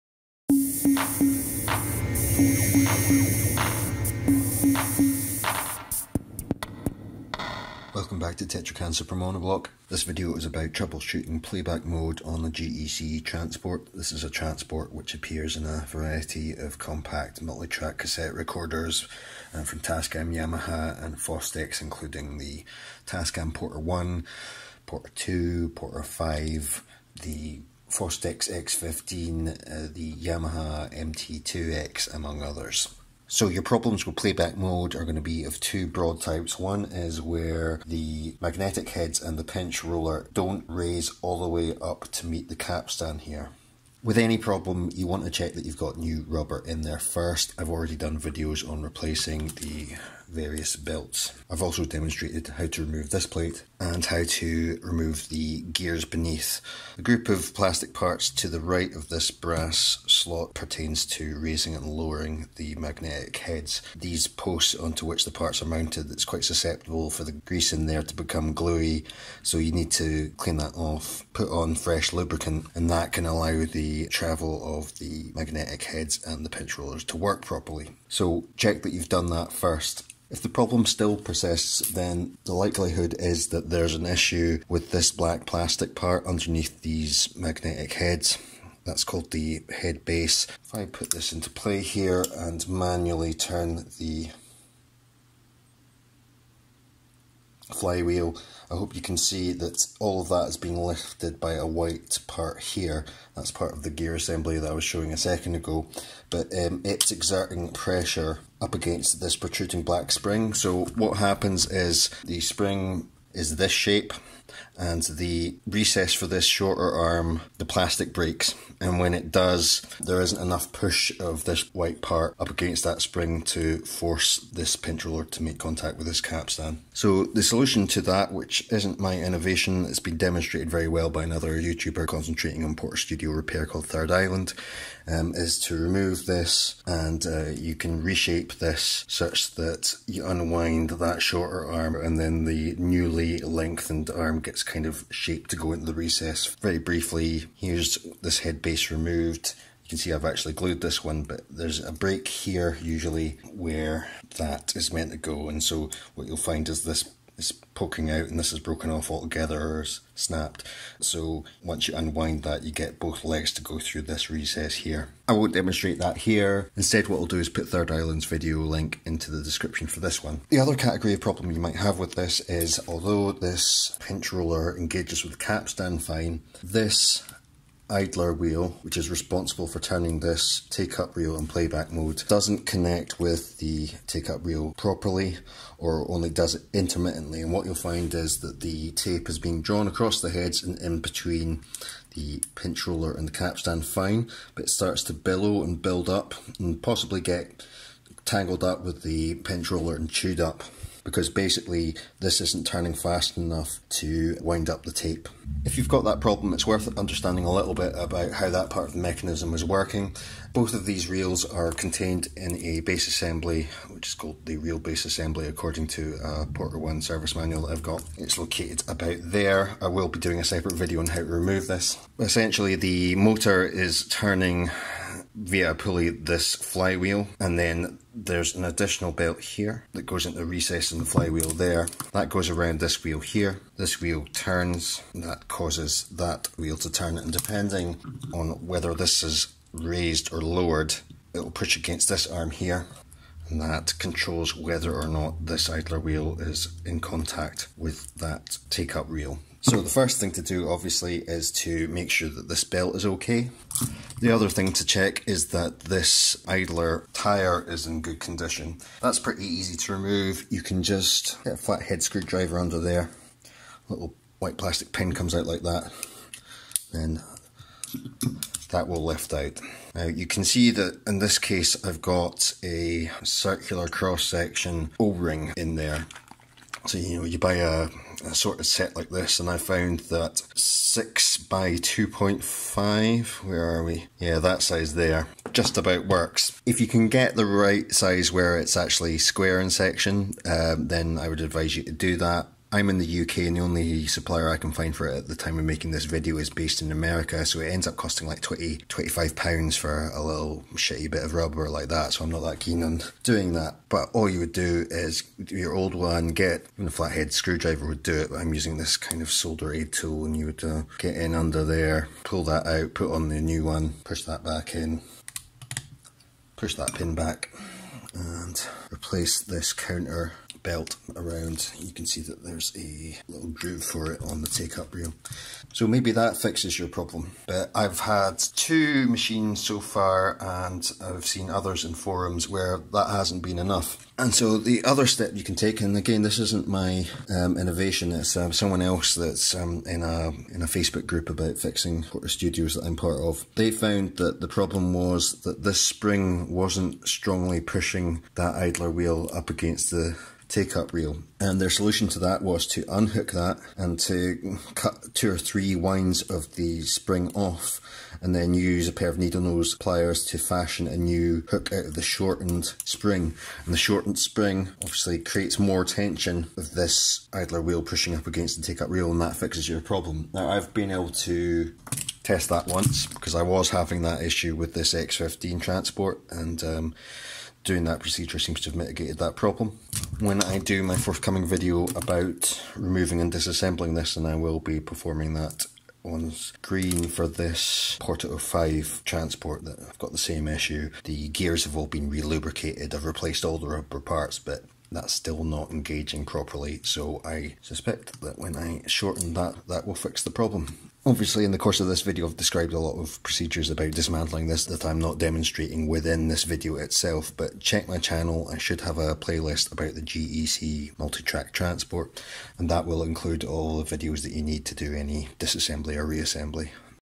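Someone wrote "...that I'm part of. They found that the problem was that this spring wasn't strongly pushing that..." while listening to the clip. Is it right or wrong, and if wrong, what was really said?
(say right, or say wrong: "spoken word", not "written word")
right.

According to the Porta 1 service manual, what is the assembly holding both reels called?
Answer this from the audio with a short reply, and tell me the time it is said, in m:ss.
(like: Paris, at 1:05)
reel base assembly, at 3:34.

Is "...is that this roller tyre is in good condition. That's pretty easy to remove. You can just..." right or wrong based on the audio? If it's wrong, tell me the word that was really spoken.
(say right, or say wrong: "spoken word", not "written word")
wrong: "idler", not "roller".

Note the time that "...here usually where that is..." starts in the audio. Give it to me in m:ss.
2:32.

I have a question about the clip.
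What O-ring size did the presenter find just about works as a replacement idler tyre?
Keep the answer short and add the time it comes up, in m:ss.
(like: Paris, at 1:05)
6 by 2.5, at 4:40.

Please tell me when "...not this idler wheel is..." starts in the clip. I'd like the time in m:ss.
4:05.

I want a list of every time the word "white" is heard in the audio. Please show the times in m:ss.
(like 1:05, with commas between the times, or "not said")
1:41, 2:01, 4:24.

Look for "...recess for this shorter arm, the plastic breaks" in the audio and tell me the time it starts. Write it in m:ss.
1:55.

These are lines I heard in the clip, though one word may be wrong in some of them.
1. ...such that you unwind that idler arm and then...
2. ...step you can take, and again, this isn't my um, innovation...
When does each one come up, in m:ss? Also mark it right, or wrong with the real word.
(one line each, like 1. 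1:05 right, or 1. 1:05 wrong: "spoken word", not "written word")
1. 2:19 wrong: "shorter", not "idler"
2. 5:35 right.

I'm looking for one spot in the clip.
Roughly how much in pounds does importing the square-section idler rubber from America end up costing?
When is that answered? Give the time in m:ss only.
4:58.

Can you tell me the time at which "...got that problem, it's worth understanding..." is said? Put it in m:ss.
3:25.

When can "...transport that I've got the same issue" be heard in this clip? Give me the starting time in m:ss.
6:29.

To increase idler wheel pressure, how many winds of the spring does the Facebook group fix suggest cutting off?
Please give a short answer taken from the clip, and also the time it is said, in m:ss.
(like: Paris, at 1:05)
2 or 3, at 5:55.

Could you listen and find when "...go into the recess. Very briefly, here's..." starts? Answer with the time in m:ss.
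2:25.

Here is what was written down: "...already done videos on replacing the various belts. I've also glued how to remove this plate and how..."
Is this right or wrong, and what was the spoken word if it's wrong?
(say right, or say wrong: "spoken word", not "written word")
wrong: "demonstrated", not "glued".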